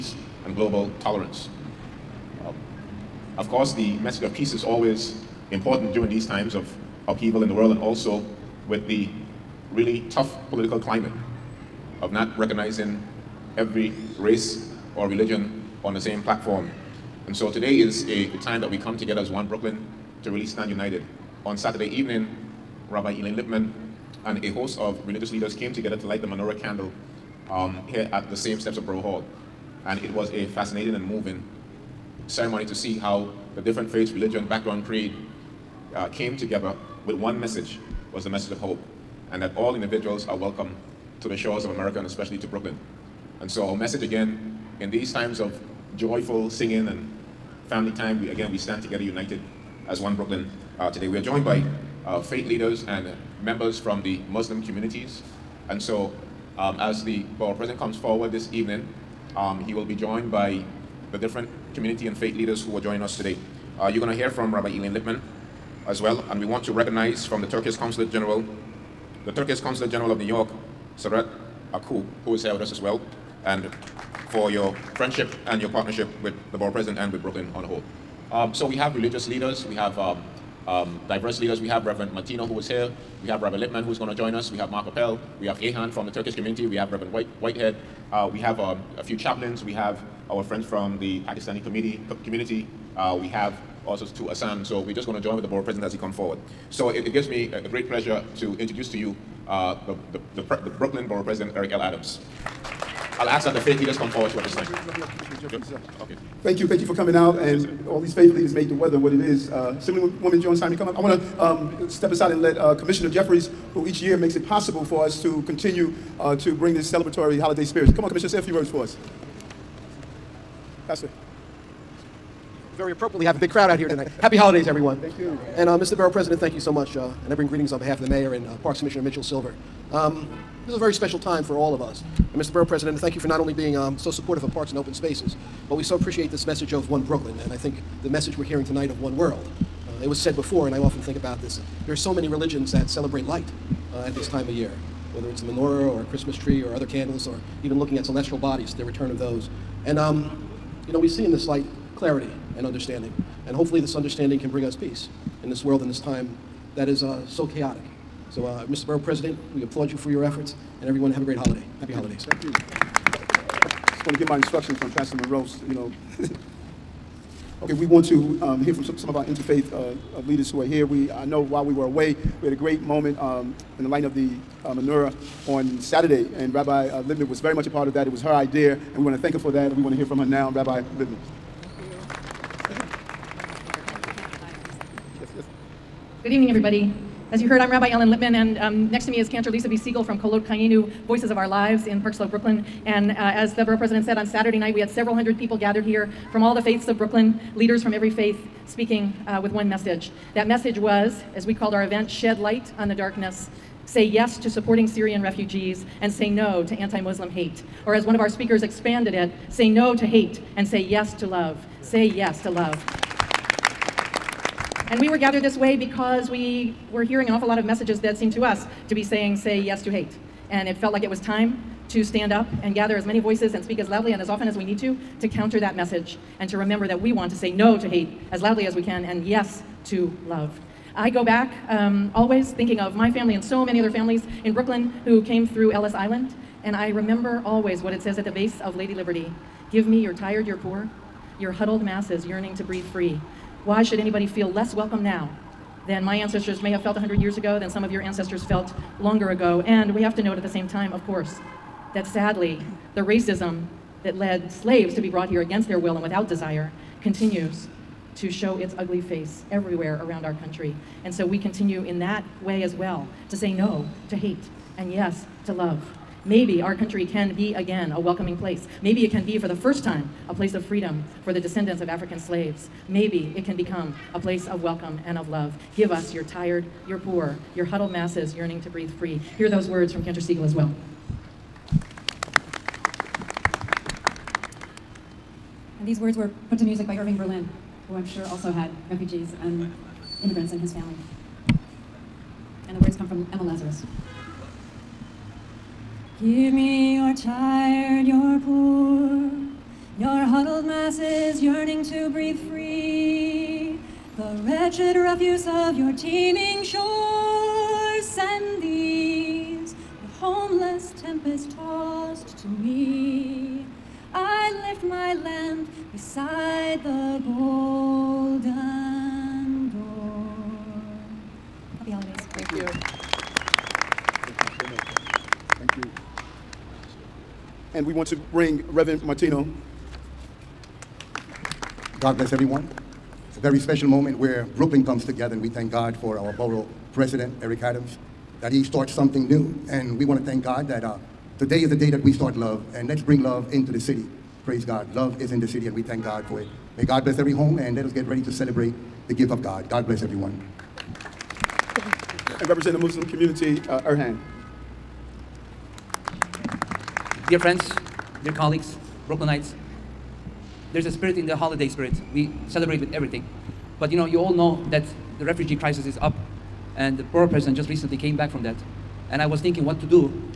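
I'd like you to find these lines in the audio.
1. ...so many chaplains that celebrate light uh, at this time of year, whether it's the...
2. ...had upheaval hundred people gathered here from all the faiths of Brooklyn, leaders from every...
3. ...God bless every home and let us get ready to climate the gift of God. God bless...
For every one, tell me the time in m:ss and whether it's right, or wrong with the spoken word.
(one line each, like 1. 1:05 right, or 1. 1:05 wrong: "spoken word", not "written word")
1. 2:21 wrong: "religions", not "chaplains"
2. 3:14 wrong: "several", not "upheaval"
3. 5:46 wrong: "celebrate", not "climate".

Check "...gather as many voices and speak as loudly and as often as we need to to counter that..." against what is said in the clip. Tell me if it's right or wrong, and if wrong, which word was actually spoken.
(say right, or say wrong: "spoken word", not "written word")
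right.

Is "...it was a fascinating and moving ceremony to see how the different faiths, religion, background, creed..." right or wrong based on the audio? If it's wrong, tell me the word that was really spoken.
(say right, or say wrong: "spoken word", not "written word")
right.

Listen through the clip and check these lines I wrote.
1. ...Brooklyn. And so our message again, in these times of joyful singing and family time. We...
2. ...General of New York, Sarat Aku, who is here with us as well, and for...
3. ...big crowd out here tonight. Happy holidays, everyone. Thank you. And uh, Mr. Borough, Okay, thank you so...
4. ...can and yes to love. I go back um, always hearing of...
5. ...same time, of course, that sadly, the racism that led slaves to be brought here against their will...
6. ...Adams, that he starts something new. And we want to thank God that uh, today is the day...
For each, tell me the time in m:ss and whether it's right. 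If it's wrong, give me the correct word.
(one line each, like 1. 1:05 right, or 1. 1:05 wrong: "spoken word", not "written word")
1. 0:42 right
2. 1:09 right
3. 2:03 wrong: "President", not "Okay"
4. 3:48 wrong: "thinking", not "hearing"
5. 4:10 right
6. 5:37 right.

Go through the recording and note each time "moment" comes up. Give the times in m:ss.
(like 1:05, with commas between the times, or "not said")
2:52, 5:33.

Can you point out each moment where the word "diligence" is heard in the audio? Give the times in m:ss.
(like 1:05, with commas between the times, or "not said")
not said.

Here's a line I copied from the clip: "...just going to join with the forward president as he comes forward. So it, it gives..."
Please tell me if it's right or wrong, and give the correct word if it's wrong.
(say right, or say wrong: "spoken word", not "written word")
wrong: "board", not "forward".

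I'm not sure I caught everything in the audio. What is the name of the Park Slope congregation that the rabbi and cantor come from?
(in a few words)
Kolot Chayeinu.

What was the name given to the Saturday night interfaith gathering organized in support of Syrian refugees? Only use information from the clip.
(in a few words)
Shed Light on the Darkness.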